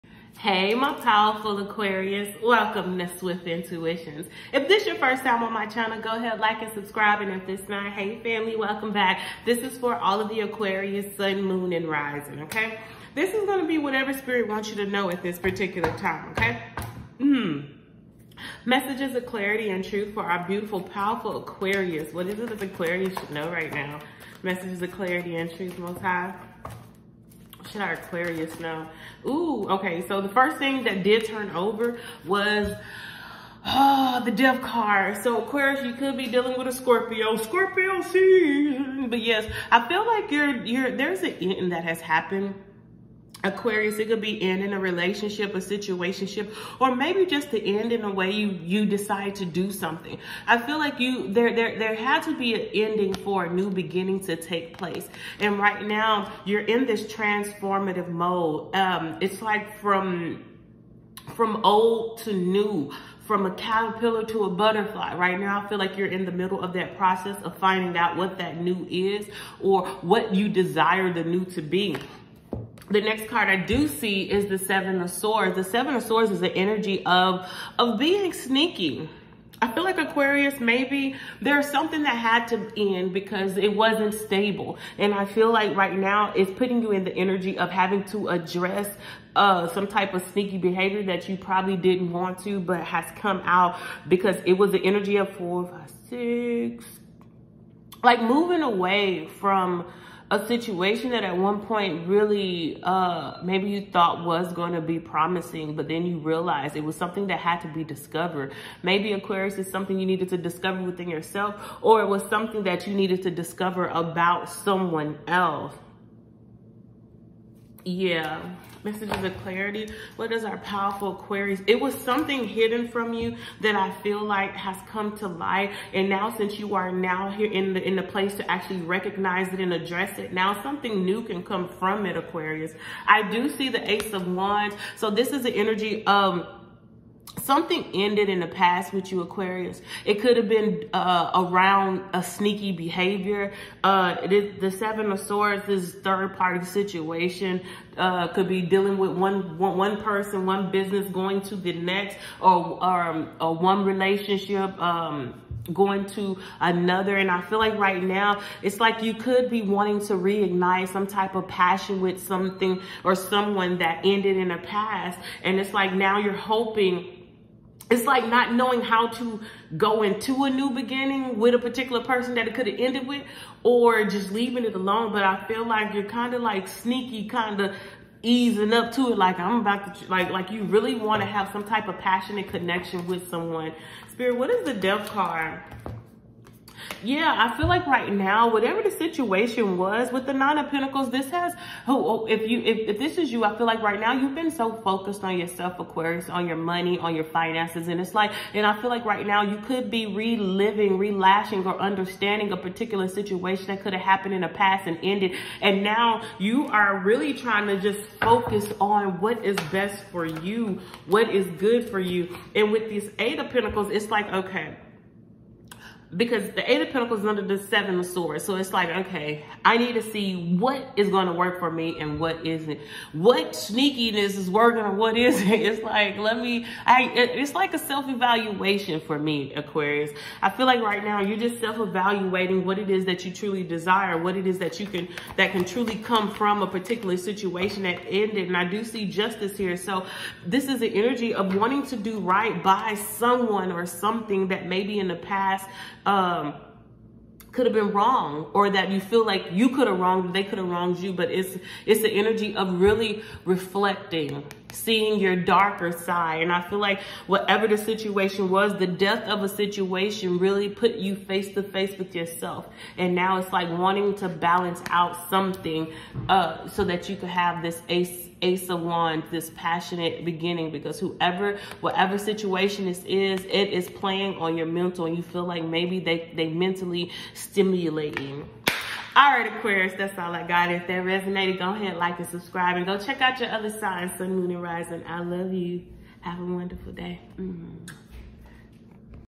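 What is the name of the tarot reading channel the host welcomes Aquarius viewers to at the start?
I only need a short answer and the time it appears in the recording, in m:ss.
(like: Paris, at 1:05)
Swift Intuitions, at 0:03.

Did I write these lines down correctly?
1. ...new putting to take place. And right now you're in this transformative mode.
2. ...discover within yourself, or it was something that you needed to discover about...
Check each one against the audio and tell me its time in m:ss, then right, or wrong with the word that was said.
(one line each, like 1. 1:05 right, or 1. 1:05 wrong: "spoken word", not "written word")
1. 0:53 wrong: "beginning", not "putting"
2. 1:50 right.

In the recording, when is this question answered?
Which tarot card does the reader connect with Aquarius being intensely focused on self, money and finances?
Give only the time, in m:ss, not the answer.
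3:10.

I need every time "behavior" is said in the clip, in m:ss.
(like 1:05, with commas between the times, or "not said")
1:30, 2:22.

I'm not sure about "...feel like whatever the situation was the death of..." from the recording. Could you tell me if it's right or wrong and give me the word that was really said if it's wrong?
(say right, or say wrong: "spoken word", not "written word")
right.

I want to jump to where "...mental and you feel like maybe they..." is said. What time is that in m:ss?
4:34.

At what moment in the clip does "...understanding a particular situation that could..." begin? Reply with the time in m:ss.
3:21.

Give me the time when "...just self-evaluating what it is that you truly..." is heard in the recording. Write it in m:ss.
3:51.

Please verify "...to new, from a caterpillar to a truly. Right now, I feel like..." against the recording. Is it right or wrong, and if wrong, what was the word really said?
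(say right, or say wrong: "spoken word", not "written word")
wrong: "butterfly", not "truly".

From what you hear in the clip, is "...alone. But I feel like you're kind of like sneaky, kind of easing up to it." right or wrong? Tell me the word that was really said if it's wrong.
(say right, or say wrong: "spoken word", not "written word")
right.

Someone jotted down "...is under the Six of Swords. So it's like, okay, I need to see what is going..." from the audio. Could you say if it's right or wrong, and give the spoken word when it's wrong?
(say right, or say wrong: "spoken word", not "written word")
wrong: "Seven", not "Six".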